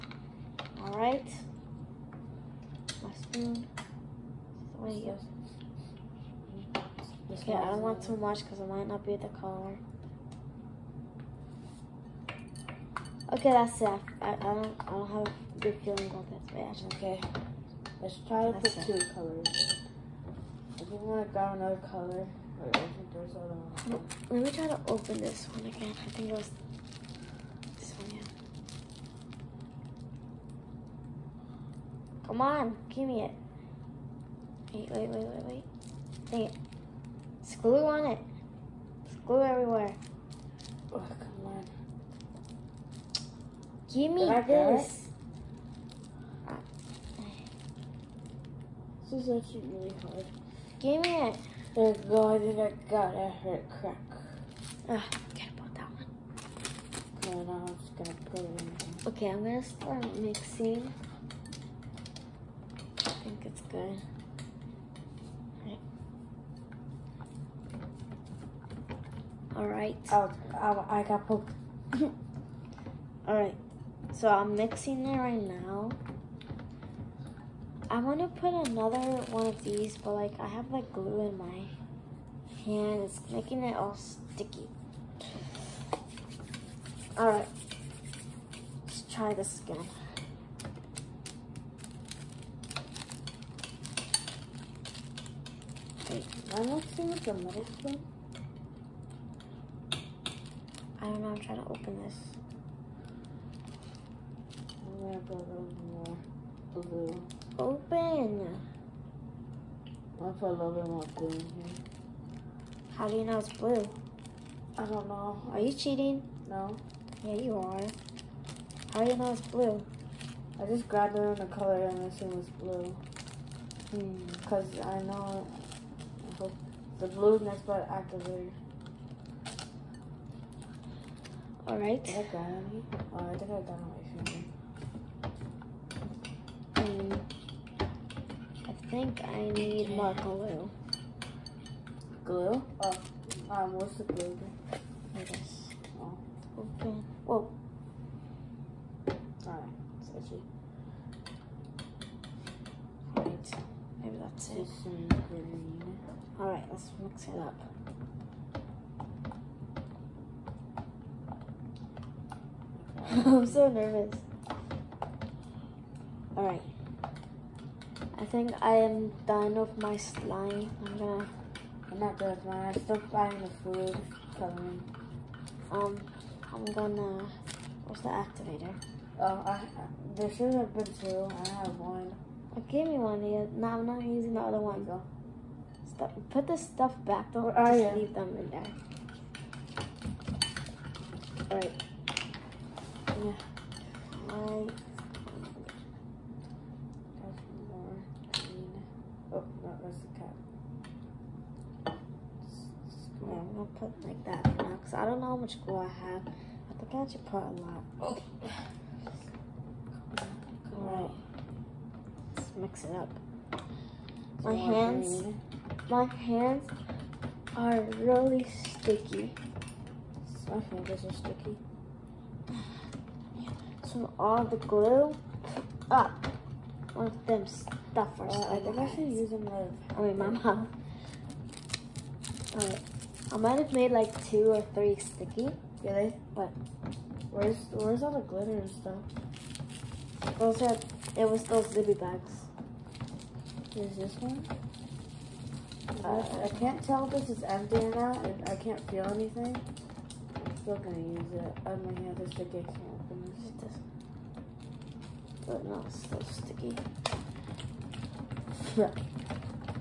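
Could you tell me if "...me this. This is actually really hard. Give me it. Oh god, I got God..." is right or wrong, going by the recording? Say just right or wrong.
right.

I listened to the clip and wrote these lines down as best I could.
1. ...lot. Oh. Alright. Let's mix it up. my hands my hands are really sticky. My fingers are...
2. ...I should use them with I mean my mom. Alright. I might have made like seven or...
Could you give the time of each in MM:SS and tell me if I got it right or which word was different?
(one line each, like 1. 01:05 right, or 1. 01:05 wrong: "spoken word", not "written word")
1. 03:27 right
2. 03:48 wrong: "two", not "seven".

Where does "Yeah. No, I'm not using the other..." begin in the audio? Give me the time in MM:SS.
03:03.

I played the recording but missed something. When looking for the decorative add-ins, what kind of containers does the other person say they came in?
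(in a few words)
zippy bags.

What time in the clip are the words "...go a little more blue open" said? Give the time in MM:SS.
01:45.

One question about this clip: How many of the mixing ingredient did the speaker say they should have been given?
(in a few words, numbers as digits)
2.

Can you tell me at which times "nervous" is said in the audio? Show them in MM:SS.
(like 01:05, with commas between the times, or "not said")
02:43.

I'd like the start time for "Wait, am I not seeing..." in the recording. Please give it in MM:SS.
01:36.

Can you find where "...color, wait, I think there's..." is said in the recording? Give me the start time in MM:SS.
00:21.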